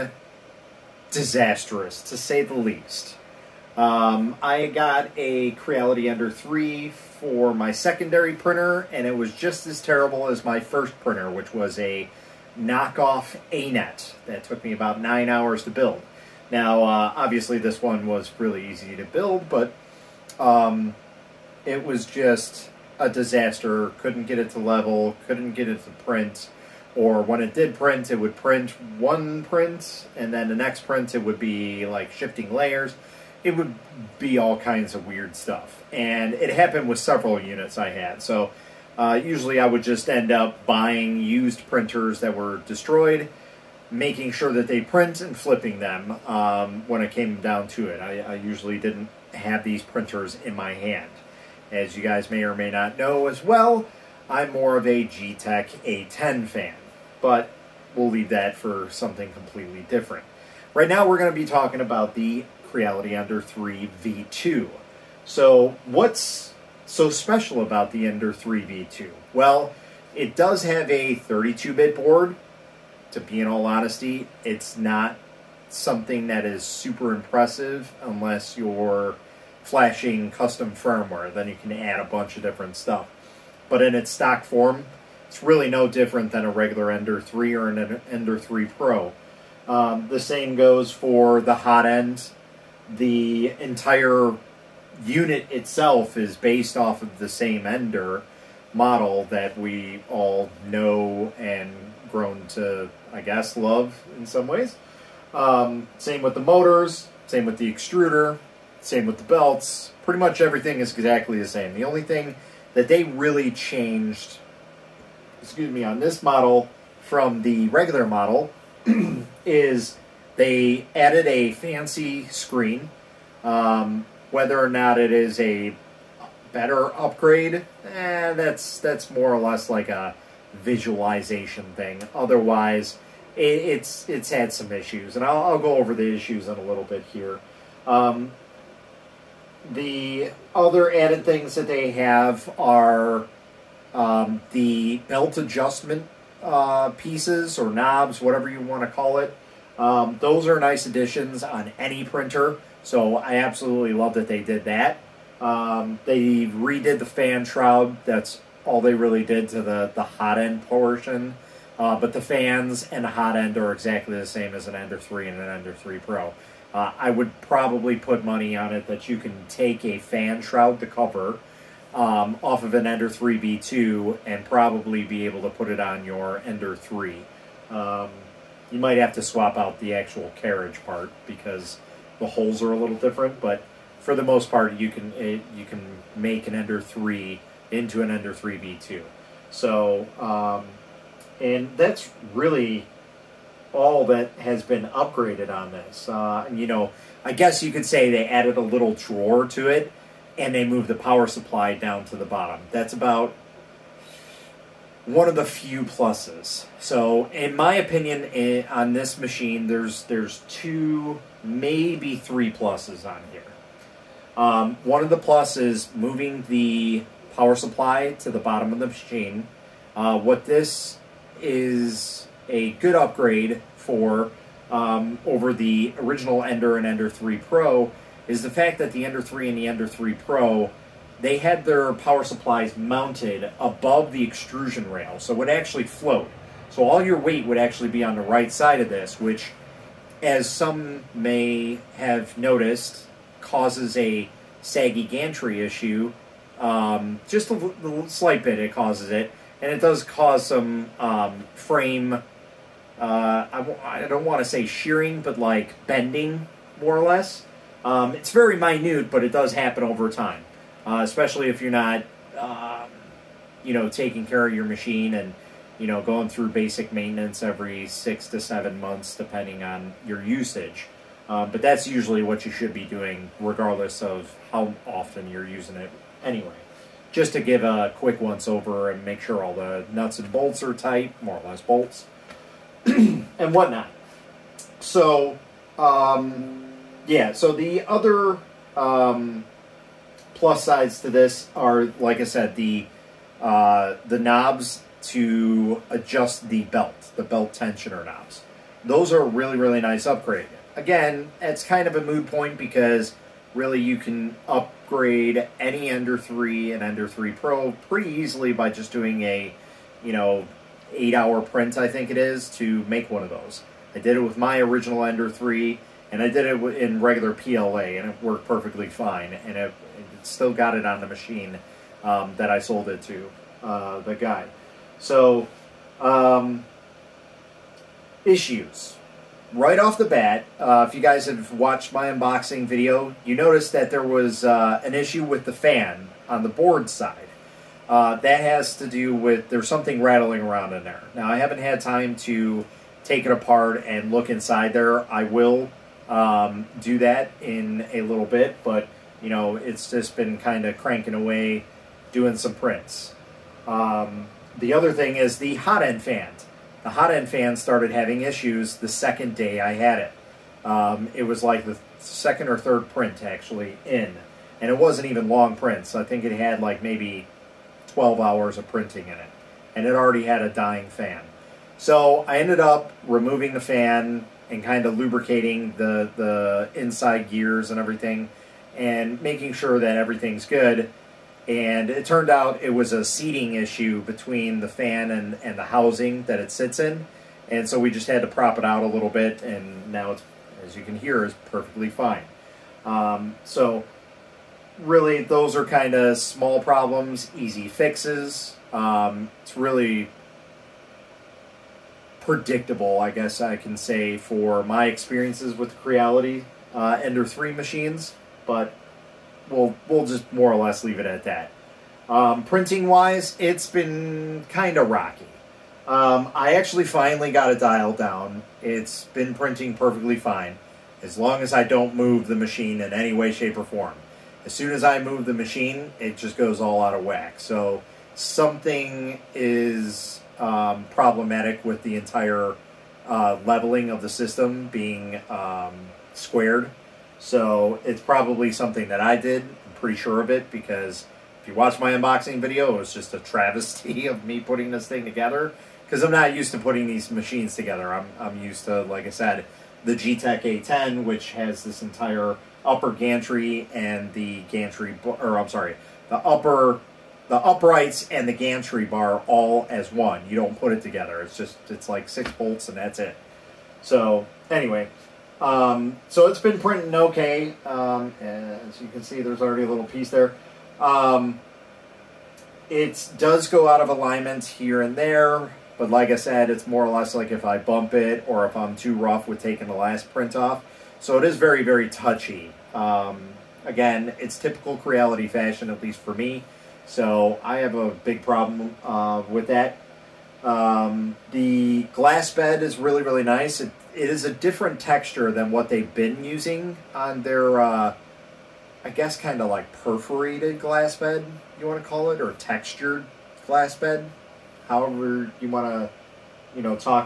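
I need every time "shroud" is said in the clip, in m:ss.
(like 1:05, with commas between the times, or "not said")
2:37, 2:50.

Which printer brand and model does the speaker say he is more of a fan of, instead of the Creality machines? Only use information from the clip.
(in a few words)
Geeetech A10.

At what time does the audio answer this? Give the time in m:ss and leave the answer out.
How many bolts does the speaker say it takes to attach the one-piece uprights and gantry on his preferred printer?
7:42.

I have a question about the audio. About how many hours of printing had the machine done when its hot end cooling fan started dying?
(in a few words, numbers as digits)
12 hours.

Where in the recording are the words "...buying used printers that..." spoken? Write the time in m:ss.
0:40.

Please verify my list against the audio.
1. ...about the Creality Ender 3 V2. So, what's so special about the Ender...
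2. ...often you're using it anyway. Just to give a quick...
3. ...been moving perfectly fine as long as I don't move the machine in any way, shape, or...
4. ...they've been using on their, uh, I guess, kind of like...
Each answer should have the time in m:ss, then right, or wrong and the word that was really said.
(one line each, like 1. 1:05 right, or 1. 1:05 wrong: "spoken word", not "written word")
1. 1:01 right
2. 4:34 right
3. 6:59 wrong: "printing", not "moving"
4. 8:15 right.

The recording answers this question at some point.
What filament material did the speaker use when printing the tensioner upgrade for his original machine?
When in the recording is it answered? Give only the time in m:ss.
5:17.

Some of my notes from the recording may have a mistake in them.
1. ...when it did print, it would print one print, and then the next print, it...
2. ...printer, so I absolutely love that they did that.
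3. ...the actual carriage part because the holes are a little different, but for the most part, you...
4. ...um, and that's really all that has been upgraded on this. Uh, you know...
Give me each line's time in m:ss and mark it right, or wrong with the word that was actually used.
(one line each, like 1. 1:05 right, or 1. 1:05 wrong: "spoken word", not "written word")
1. 0:27 right
2. 2:32 right
3. 2:59 right
4. 3:10 right.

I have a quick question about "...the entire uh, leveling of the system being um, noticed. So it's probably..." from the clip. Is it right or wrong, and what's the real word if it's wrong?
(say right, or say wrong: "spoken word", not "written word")
wrong: "squared", not "noticed".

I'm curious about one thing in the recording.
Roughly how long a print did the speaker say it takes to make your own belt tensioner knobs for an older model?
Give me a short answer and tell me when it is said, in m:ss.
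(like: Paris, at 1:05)
8 hours, at 5:10.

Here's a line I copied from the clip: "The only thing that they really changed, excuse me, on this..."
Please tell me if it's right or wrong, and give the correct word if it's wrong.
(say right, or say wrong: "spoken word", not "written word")
right.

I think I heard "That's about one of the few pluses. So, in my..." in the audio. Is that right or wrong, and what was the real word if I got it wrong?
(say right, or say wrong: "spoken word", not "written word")
right.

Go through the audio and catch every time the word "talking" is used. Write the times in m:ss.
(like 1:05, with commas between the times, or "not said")
1:01.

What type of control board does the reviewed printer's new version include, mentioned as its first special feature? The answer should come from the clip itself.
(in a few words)
32 bit board.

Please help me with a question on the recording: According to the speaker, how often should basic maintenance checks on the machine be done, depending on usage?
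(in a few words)
every 6 to 7 months.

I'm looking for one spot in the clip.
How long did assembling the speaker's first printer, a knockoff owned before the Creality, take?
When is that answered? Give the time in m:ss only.
0:15.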